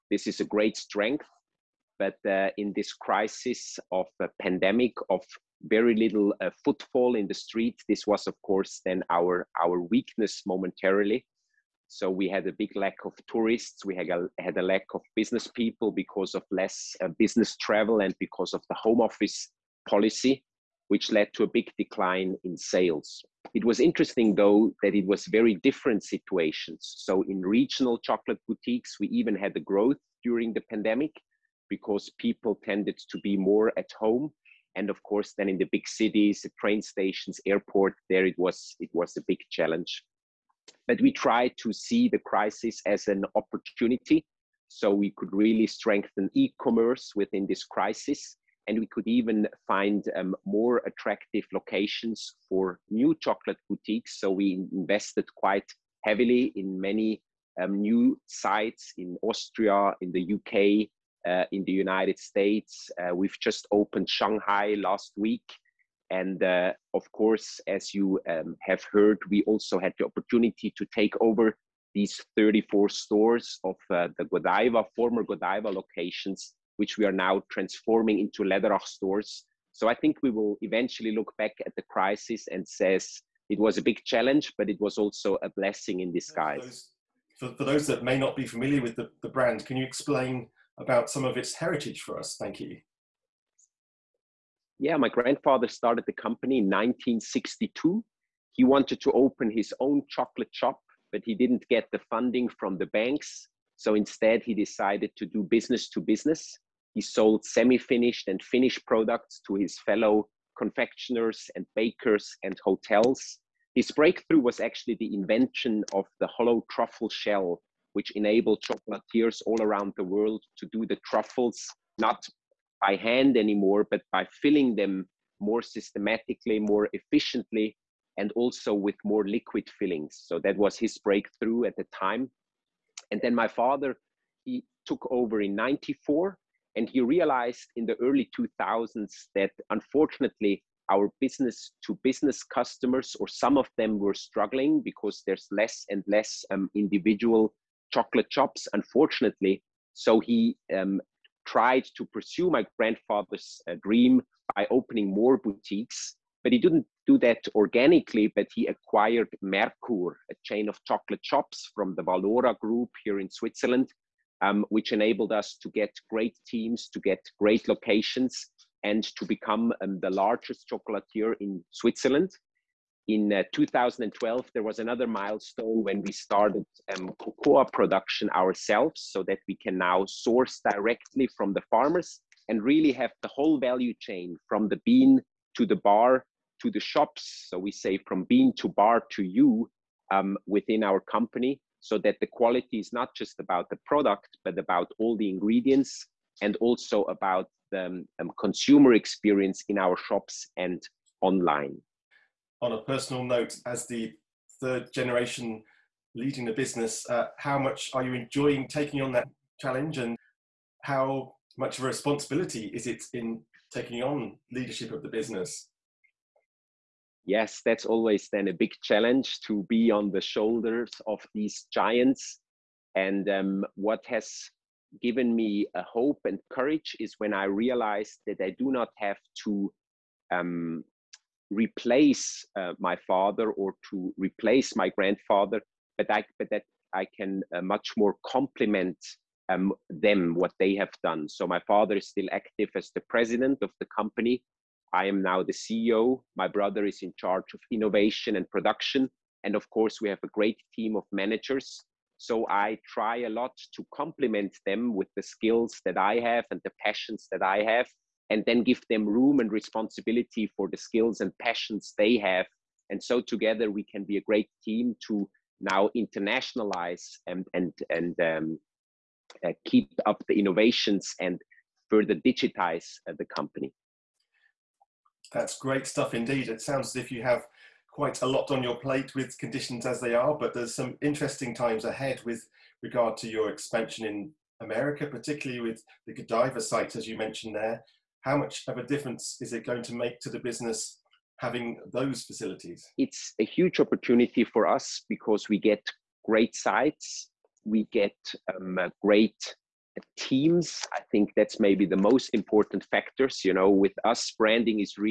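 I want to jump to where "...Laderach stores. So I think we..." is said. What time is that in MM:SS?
01:18.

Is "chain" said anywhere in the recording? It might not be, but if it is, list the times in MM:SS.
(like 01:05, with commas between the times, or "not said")
02:40, 03:03.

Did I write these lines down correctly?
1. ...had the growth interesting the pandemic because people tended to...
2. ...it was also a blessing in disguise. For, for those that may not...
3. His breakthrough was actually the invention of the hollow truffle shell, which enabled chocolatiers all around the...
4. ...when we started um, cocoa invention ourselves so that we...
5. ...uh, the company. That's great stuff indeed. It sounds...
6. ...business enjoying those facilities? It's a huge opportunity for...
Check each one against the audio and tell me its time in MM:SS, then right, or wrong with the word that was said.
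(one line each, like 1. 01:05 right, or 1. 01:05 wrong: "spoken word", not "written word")
1. 00:29 wrong: "during", not "interesting"
2. 01:24 right
3. 01:53 right
4. 02:55 wrong: "production", not "invention"
5. 04:33 right
6. 04:50 wrong: "having", not "enjoying".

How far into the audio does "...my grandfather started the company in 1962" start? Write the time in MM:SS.
01:34.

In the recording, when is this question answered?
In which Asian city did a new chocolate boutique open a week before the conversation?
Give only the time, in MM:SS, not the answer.
01:04.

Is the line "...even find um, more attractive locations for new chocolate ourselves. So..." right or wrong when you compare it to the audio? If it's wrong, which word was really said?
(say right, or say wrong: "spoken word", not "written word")
wrong: "boutiques", not "ourselves".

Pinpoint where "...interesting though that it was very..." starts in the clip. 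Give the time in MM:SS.
00:23.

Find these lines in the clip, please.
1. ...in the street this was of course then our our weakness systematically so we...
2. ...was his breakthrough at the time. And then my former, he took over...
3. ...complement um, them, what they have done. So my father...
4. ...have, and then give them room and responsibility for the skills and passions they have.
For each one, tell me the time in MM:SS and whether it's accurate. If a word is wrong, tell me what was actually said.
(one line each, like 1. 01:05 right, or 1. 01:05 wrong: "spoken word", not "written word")
1. 00:07 wrong: "momentarily", not "systematically"
2. 02:10 wrong: "father", not "former"
3. 03:58 right
4. 04:17 right.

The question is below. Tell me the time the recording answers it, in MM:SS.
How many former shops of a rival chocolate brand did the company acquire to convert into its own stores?
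01:12.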